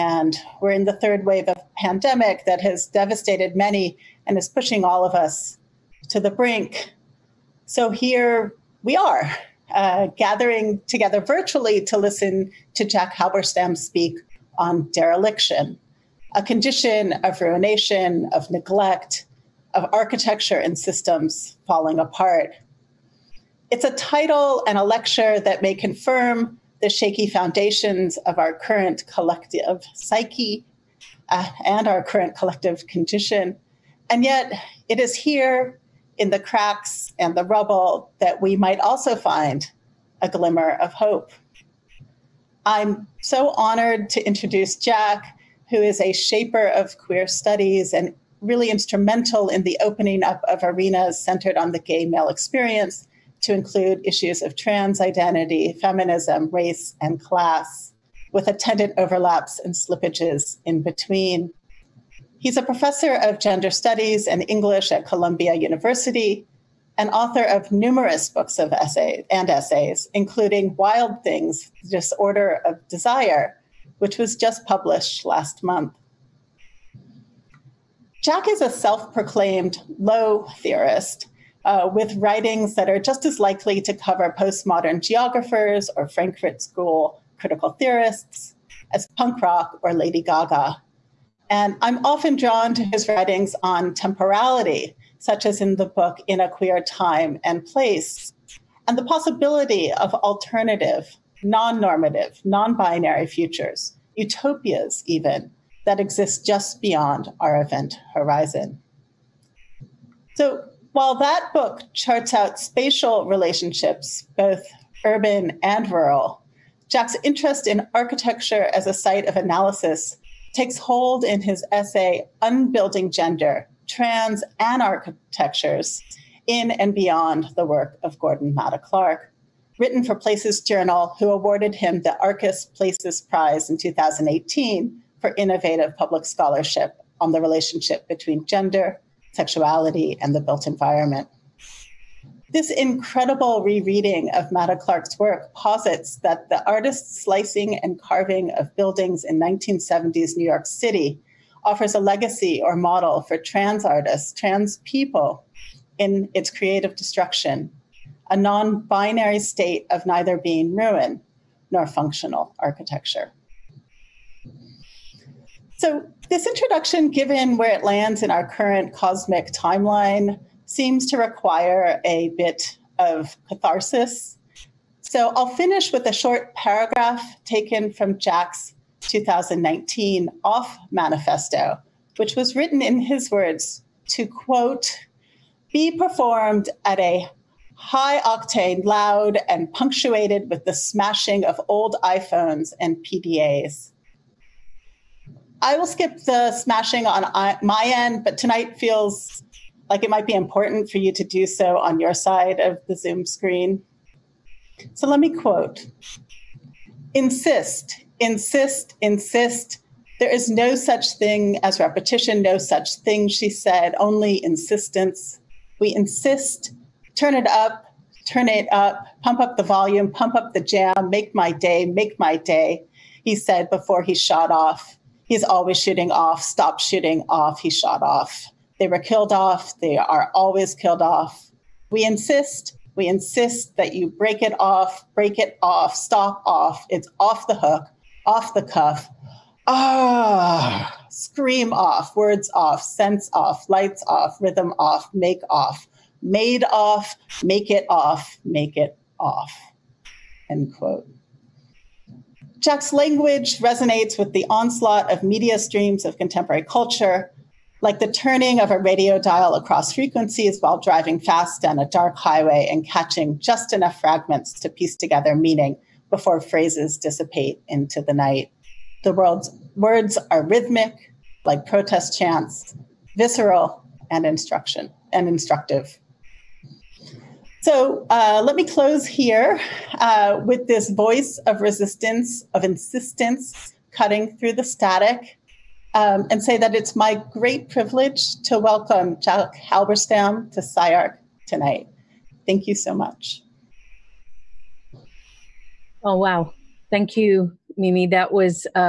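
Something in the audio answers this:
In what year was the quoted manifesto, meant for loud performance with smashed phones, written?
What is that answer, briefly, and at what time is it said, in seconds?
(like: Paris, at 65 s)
2019, at 178 s.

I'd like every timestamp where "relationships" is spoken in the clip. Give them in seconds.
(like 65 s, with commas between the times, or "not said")
113 s, 137 s.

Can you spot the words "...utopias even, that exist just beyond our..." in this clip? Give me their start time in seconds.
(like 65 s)
104 s.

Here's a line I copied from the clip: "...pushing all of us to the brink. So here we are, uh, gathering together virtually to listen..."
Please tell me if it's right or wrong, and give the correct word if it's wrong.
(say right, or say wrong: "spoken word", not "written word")
right.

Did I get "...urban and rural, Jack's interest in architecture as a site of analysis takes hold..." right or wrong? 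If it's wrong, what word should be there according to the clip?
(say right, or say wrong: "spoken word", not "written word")
right.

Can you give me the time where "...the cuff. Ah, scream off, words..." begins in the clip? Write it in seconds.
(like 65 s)
238 s.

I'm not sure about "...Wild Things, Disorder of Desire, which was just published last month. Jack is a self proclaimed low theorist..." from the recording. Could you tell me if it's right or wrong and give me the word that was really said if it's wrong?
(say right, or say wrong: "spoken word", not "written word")
right.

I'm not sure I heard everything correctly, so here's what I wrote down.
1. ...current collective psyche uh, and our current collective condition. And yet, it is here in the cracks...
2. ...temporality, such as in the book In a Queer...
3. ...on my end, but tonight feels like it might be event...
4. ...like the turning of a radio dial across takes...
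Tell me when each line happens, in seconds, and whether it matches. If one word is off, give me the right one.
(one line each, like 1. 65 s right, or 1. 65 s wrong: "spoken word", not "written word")
1. 28 s right
2. 93 s right
3. 197 s wrong: "important", not "event"
4. 257 s wrong: "frequencies", not "takes".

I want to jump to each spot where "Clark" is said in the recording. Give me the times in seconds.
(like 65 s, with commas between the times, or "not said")
128 s, 144 s.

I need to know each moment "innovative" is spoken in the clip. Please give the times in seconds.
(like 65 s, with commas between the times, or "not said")
135 s.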